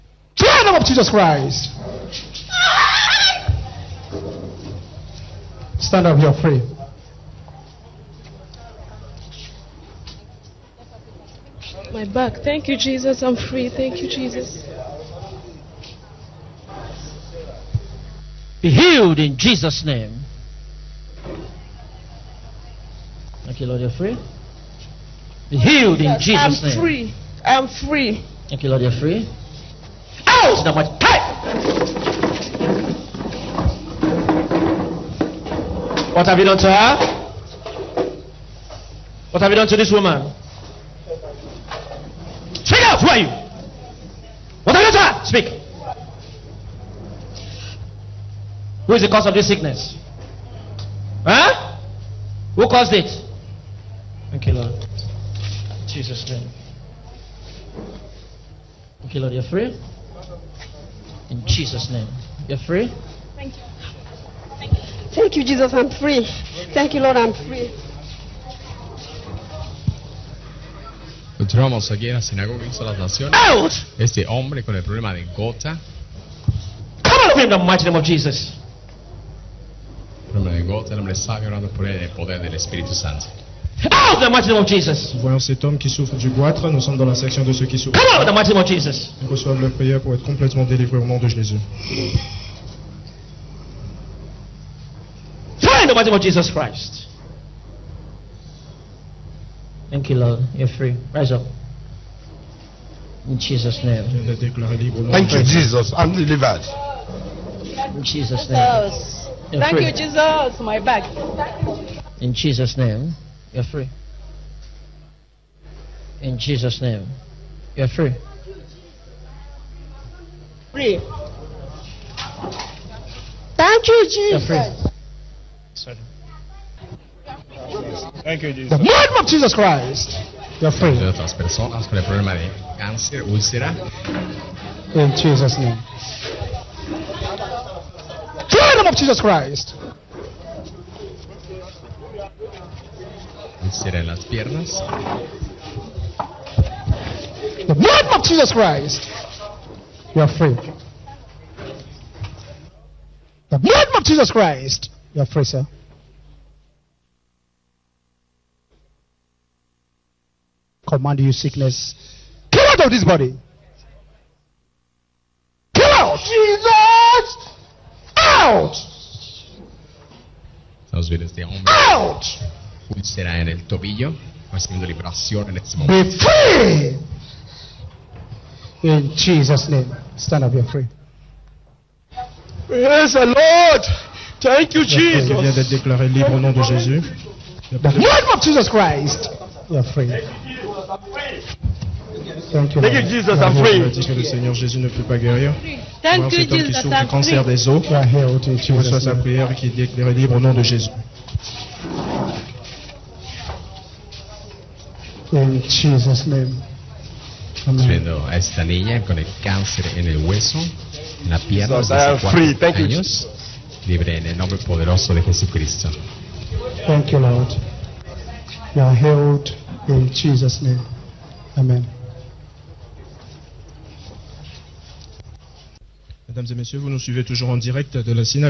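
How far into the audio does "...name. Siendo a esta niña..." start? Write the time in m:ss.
3:26.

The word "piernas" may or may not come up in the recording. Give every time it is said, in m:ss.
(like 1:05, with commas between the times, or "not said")
2:24, 3:31.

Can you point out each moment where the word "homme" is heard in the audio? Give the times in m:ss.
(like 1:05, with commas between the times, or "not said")
1:25, 3:16.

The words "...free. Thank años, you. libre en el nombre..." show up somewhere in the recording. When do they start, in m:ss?
3:32.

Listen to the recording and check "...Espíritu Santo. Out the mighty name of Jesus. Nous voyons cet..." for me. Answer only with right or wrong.
right.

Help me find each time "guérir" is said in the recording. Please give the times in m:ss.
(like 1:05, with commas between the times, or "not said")
3:15.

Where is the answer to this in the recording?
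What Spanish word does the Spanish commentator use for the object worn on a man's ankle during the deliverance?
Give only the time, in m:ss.
2:52.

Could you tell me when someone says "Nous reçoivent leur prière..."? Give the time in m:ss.
1:29.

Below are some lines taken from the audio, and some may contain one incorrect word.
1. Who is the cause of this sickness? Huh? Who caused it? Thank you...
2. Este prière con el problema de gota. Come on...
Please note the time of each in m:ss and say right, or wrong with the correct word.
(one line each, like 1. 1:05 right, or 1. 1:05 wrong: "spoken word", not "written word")
1. 0:48 right
2. 1:13 wrong: "hombre", not "prière".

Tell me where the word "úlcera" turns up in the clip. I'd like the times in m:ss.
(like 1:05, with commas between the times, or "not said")
2:13, 2:23.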